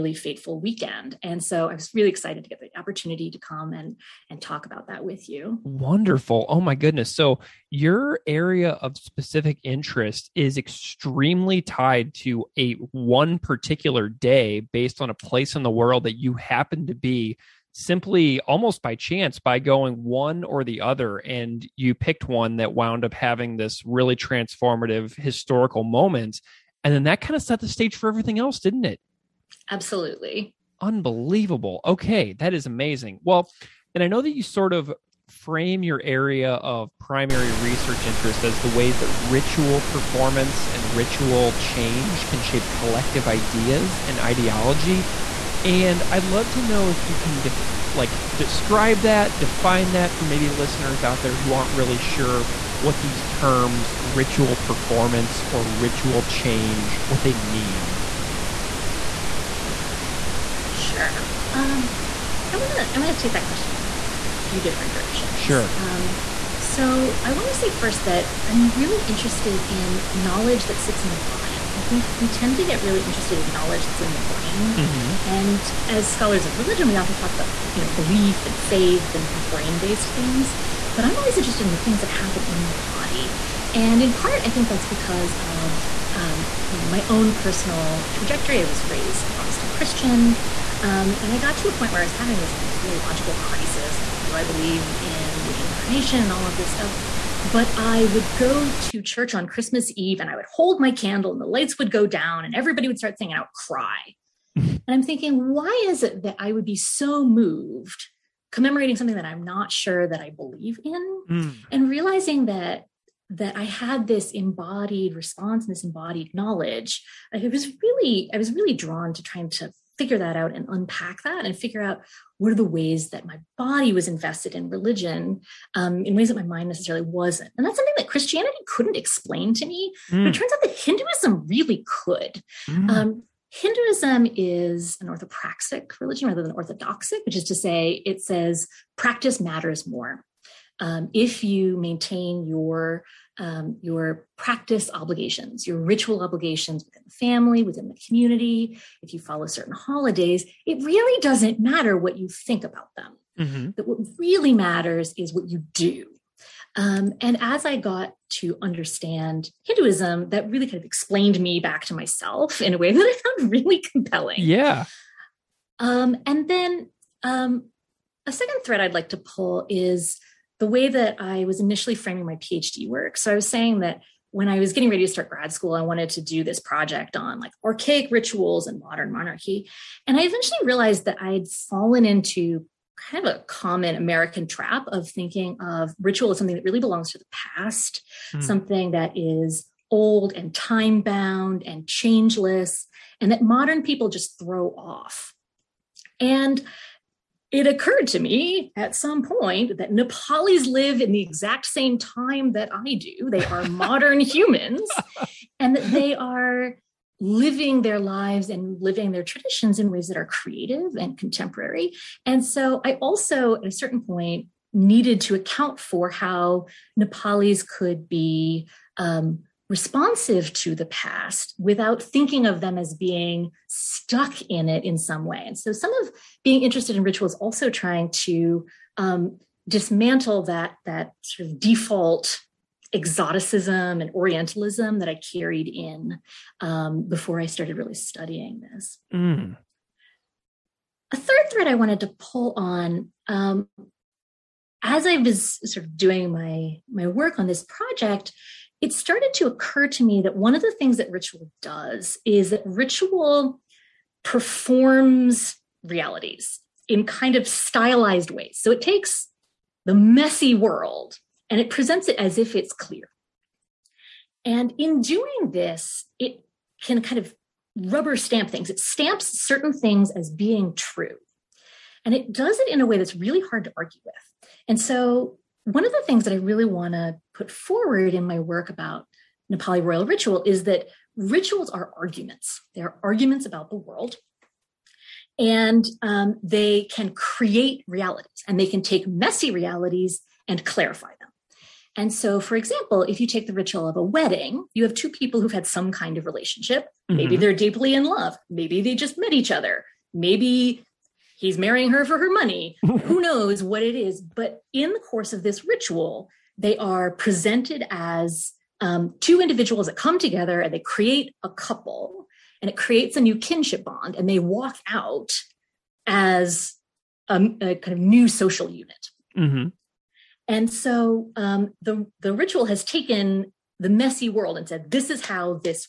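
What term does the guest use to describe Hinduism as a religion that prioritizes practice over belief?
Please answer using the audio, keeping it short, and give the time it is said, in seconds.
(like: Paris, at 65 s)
Orthopraxic, at 135 s.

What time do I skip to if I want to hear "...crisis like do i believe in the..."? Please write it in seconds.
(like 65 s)
93 s.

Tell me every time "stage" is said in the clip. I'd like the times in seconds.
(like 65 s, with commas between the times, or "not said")
27 s.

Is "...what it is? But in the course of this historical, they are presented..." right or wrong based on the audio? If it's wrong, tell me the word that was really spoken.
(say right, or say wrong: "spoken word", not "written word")
wrong: "ritual", not "historical".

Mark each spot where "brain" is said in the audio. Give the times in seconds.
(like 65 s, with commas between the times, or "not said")
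74 s, 79 s.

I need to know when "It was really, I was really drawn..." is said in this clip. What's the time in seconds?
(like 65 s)
117 s.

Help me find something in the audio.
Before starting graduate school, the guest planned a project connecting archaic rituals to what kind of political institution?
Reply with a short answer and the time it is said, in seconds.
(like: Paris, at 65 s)
Modern monarchy, at 178 s.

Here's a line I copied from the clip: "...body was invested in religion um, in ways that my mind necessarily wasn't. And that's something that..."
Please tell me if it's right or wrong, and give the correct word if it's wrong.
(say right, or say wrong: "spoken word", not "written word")
right.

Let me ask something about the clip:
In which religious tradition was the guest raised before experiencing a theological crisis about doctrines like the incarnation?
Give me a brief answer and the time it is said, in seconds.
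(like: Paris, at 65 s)
Protestant Christian, at 89 s.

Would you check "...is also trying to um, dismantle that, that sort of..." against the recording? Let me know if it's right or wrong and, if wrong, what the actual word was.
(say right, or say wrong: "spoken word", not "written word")
right.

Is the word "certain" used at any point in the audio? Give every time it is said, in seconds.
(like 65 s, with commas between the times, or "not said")
149 s, 213 s, 269 s.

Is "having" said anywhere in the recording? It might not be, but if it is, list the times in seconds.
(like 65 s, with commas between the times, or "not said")
23 s, 92 s.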